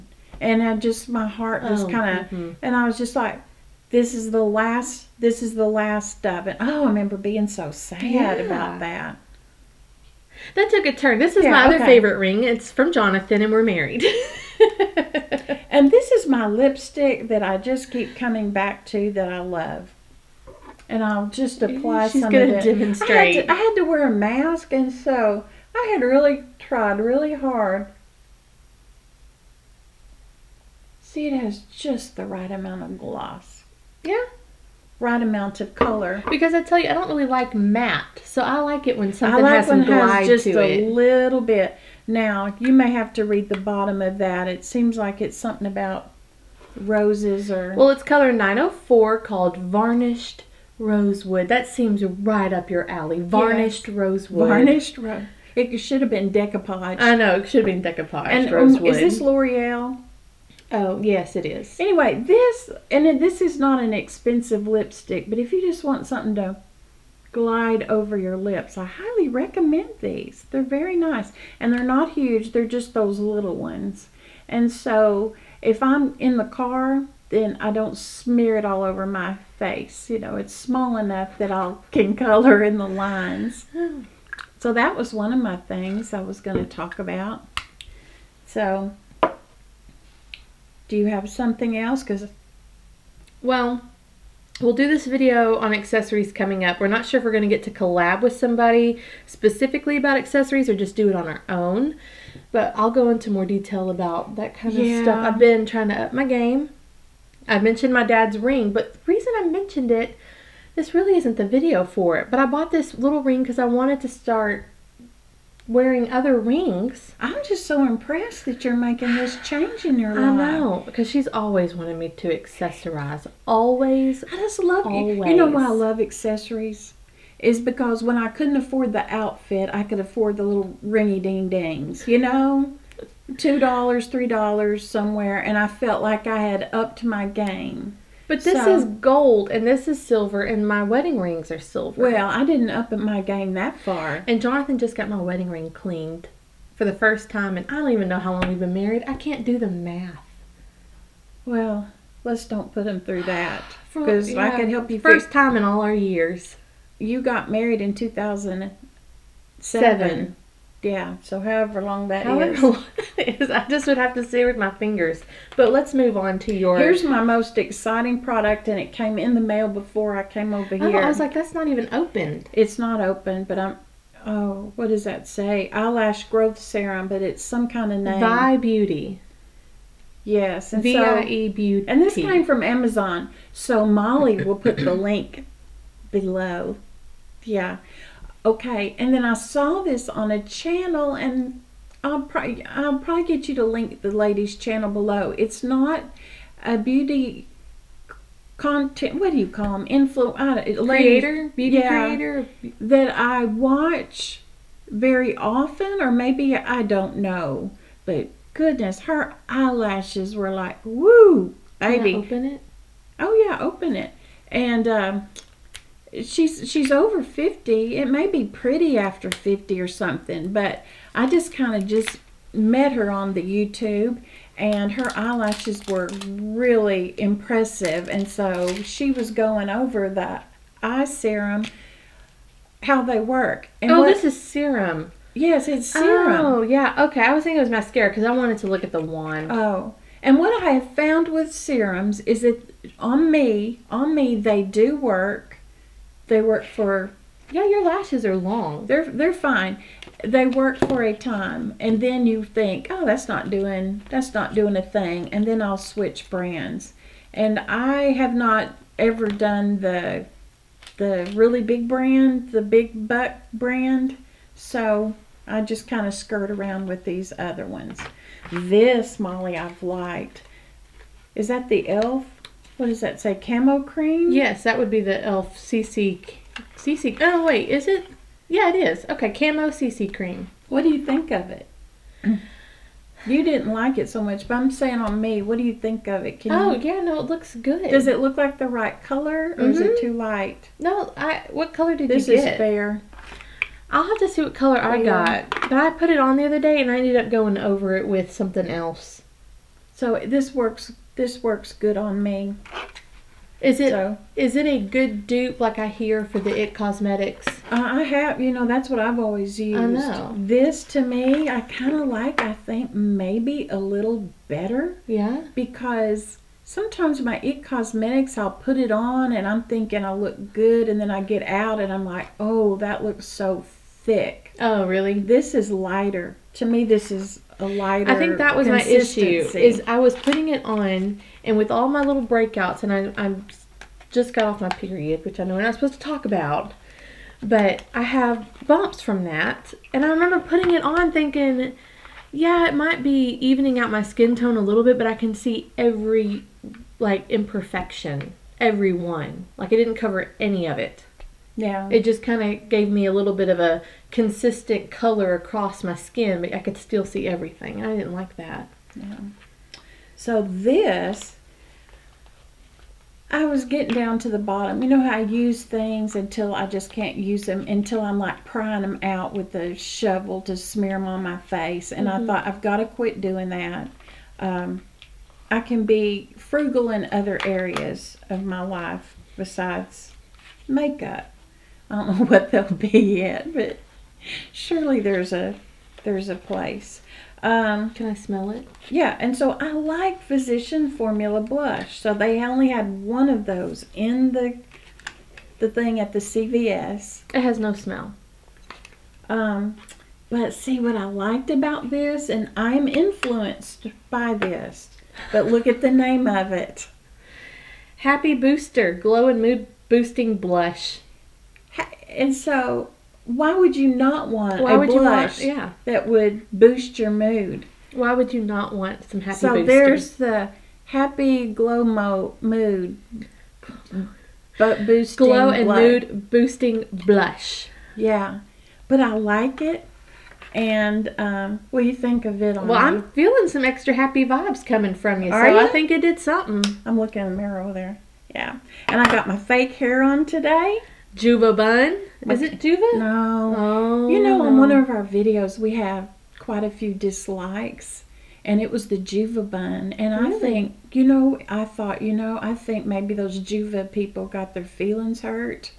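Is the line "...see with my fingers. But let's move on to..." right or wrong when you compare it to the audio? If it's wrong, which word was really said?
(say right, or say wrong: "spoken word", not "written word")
right.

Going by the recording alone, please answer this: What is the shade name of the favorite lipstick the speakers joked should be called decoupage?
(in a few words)
varnished rosewood.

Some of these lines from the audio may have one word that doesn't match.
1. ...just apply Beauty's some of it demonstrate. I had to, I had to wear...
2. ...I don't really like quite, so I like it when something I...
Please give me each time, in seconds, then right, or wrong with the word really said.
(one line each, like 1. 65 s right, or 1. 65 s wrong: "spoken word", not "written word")
1. 21 s wrong: "She", not "Beauty"
2. 36 s wrong: "matte", not "quite".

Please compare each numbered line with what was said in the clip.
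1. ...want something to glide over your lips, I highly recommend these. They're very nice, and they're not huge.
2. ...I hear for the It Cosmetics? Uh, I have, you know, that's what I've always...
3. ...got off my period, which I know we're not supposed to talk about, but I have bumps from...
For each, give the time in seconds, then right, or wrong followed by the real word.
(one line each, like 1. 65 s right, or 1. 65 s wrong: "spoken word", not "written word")
1. 65 s right
2. 305 s right
3. 334 s right.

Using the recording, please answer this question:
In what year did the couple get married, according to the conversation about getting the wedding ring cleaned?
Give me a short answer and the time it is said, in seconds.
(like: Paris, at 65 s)
2007, at 157 s.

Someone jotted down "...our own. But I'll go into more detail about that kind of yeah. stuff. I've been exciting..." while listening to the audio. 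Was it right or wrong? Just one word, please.
wrong.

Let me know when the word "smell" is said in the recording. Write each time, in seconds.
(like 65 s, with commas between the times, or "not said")
388 s, 397 s.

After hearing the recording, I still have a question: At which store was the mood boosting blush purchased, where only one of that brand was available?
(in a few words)
CVS.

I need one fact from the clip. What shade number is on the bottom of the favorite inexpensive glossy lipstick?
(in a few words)
904.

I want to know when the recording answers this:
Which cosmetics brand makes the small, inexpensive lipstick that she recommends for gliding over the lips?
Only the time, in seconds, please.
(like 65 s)
59 s.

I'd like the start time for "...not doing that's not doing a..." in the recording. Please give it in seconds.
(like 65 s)
253 s.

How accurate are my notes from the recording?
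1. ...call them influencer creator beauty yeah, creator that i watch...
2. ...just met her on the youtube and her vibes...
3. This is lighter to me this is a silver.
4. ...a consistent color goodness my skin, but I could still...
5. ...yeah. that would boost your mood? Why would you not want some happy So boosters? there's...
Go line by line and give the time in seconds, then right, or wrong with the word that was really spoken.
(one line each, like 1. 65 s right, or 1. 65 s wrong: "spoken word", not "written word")
1. 199 s right
2. 221 s wrong: "eyelashes", not "vibes"
3. 325 s wrong: "lighter", not "silver"
4. 353 s wrong: "across", not "goodness"
5. 415 s right.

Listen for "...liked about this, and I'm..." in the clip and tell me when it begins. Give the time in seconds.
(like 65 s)
401 s.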